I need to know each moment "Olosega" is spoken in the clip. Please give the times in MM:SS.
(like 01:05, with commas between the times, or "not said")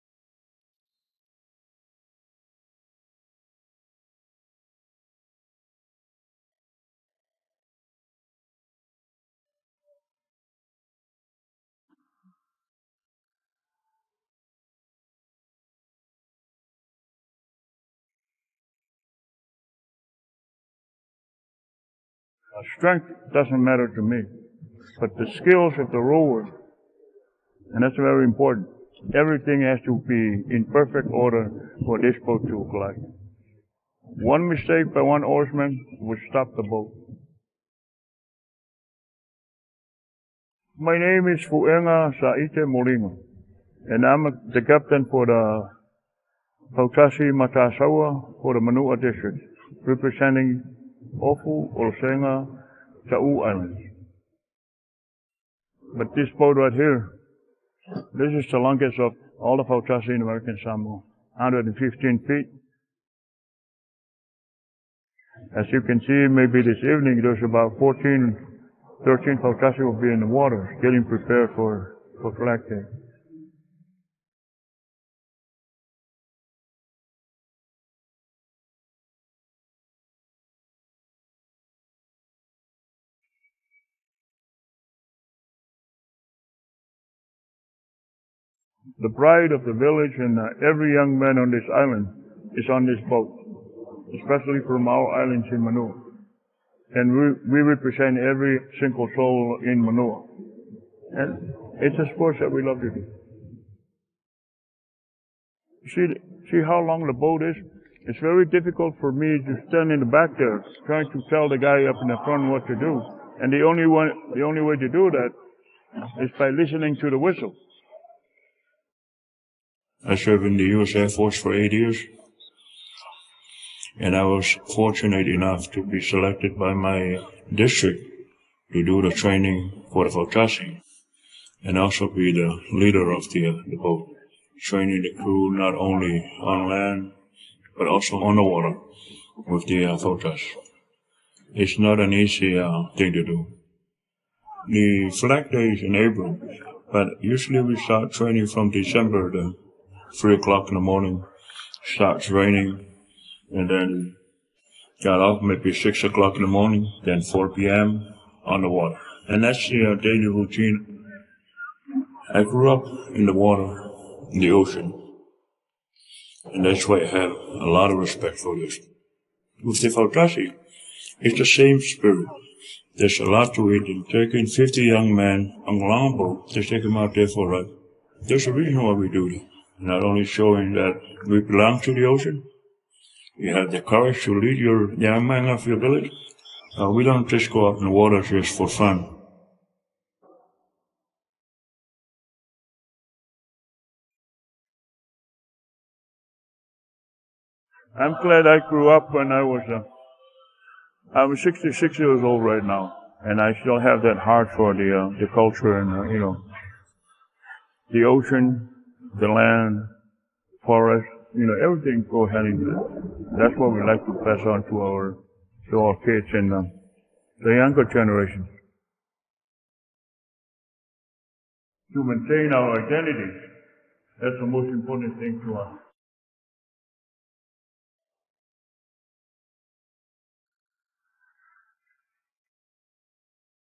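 00:51.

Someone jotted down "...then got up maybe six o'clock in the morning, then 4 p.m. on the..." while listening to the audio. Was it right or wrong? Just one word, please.
right.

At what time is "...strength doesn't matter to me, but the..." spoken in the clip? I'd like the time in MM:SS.
00:22.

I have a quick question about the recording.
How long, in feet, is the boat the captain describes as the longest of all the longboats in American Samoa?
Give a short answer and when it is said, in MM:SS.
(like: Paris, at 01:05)
115 feet, at 01:01.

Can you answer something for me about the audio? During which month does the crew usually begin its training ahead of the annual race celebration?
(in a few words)
December.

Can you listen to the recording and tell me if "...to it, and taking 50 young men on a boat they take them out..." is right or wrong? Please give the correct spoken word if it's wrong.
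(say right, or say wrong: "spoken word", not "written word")
right.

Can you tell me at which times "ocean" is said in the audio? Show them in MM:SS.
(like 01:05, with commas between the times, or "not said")
02:44, 03:02, 03:28.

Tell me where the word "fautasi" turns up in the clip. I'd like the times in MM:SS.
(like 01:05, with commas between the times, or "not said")
00:46, 00:59, 01:09, 02:10, 02:49.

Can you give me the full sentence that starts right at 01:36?
And we, we represent every single soul in Manu'a.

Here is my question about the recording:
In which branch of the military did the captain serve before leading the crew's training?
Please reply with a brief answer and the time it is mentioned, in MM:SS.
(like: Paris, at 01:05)
U.S. Air Force, at 02:00.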